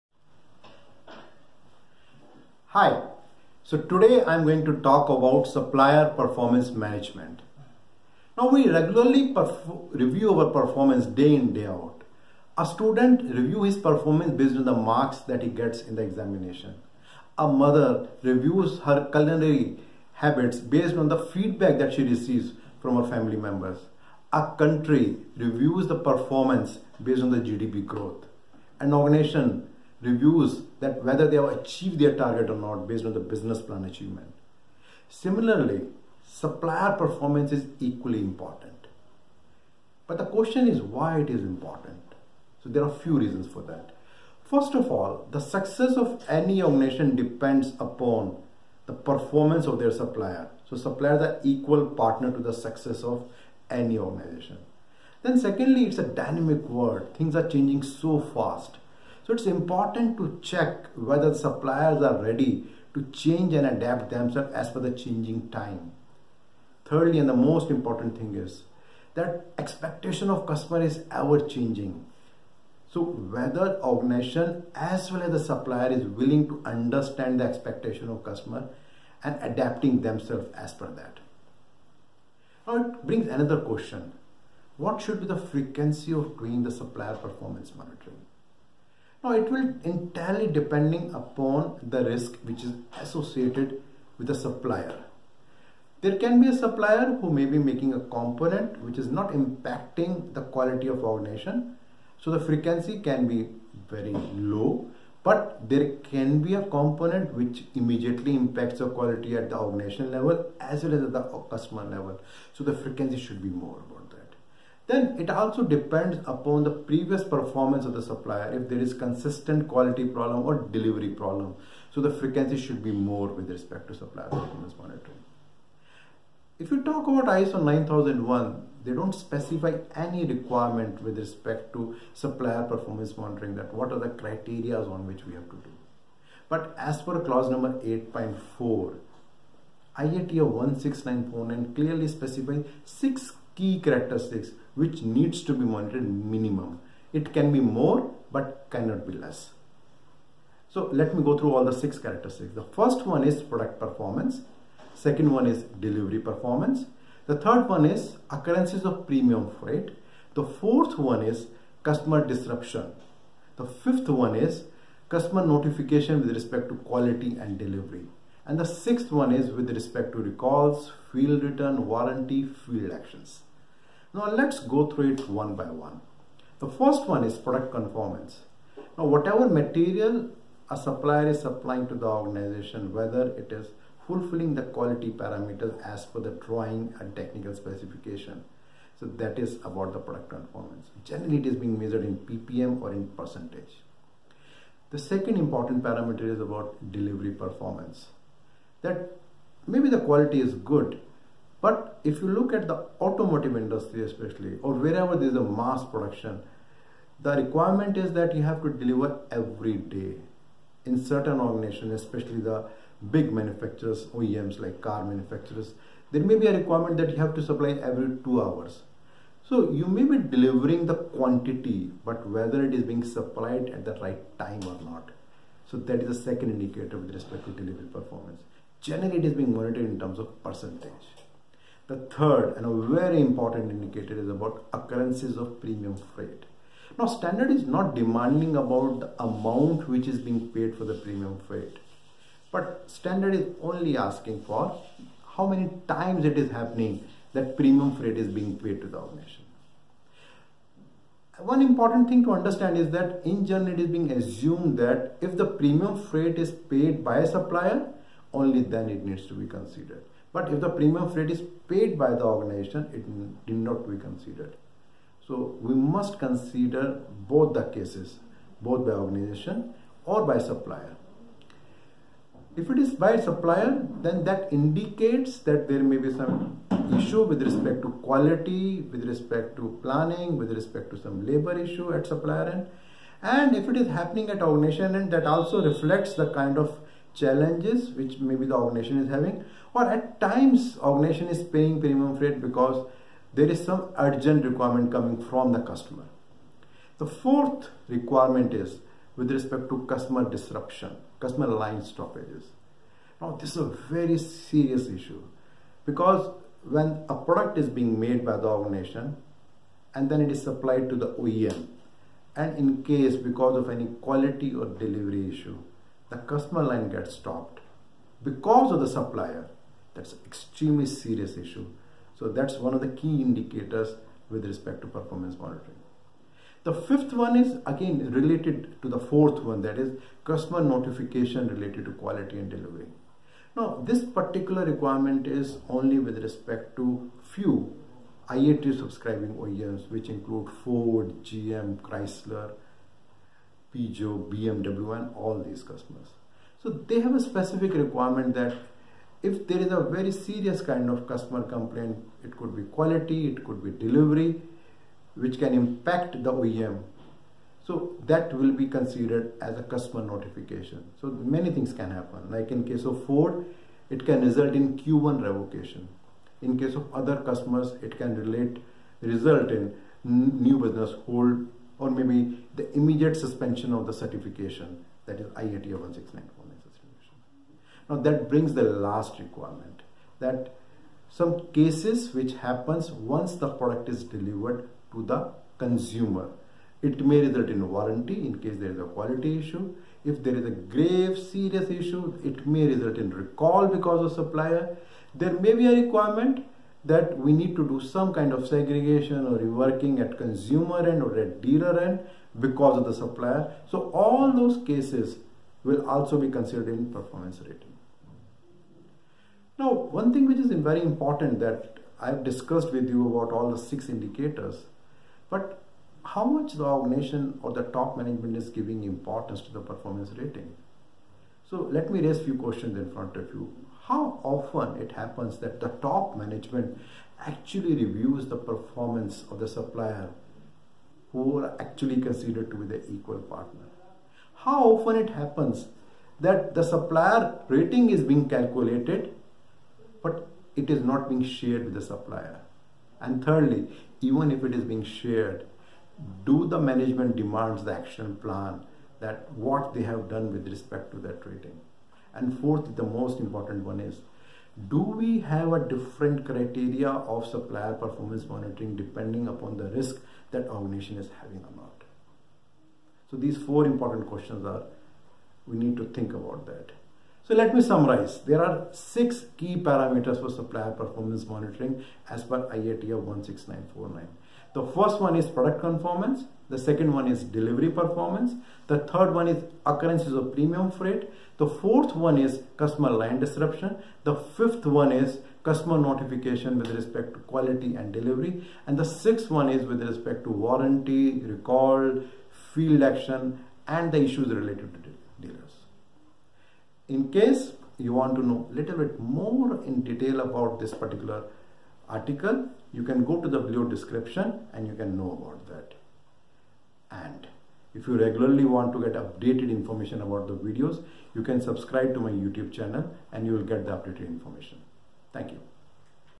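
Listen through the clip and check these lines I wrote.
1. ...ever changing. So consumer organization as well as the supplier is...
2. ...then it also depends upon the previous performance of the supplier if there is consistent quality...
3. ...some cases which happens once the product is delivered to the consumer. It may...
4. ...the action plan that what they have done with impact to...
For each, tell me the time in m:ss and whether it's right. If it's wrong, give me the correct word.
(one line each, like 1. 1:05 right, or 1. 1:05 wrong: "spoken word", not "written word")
1. 1:11 wrong: "whether", not "consumer"
2. 1:54 right
3. 6:21 right
4. 7:27 wrong: "respect", not "impact".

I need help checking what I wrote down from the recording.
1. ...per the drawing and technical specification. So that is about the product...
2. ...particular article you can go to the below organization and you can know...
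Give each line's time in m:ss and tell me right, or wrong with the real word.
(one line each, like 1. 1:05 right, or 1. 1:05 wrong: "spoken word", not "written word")
1. 3:06 right
2. 8:20 wrong: "description", not "organization".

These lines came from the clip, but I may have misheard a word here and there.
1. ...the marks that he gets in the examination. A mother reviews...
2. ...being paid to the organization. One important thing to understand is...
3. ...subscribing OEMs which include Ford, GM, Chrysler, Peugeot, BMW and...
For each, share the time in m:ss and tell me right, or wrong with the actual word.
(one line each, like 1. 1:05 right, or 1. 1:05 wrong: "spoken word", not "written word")
1. 0:14 right
2. 4:08 right
3. 5:38 right.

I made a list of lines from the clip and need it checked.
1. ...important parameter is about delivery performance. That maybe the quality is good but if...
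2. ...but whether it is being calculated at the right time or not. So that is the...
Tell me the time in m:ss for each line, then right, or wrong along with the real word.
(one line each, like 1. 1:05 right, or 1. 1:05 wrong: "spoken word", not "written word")
1. 3:15 right
2. 3:42 wrong: "supplied", not "calculated".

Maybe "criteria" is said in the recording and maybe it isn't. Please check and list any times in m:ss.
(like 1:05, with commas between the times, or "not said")
2:14, 7:36.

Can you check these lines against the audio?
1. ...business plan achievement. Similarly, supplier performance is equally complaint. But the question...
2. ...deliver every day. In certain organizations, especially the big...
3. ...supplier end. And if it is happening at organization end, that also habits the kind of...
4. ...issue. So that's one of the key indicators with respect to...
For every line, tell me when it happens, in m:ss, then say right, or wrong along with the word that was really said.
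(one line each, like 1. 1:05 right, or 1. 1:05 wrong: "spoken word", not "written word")
1. 0:33 wrong: "important", not "complaint"
2. 3:28 right
3. 4:42 wrong: "reflects", not "habits"
4. 5:21 right.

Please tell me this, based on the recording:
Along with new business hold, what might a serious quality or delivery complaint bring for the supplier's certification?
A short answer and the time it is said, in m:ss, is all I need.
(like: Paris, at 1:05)
Immediate suspension, at 6:12.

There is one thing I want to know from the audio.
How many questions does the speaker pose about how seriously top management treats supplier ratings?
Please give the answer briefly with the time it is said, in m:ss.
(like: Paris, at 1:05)
4, at 7:43.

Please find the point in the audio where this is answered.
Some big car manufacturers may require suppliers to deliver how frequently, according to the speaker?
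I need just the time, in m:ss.
3:37.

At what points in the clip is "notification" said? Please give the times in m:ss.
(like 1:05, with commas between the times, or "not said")
2:45, 5:30, 6:00, 8:05.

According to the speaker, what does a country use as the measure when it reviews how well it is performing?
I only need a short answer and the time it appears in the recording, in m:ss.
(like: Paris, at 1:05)
GDP growth, at 0:27.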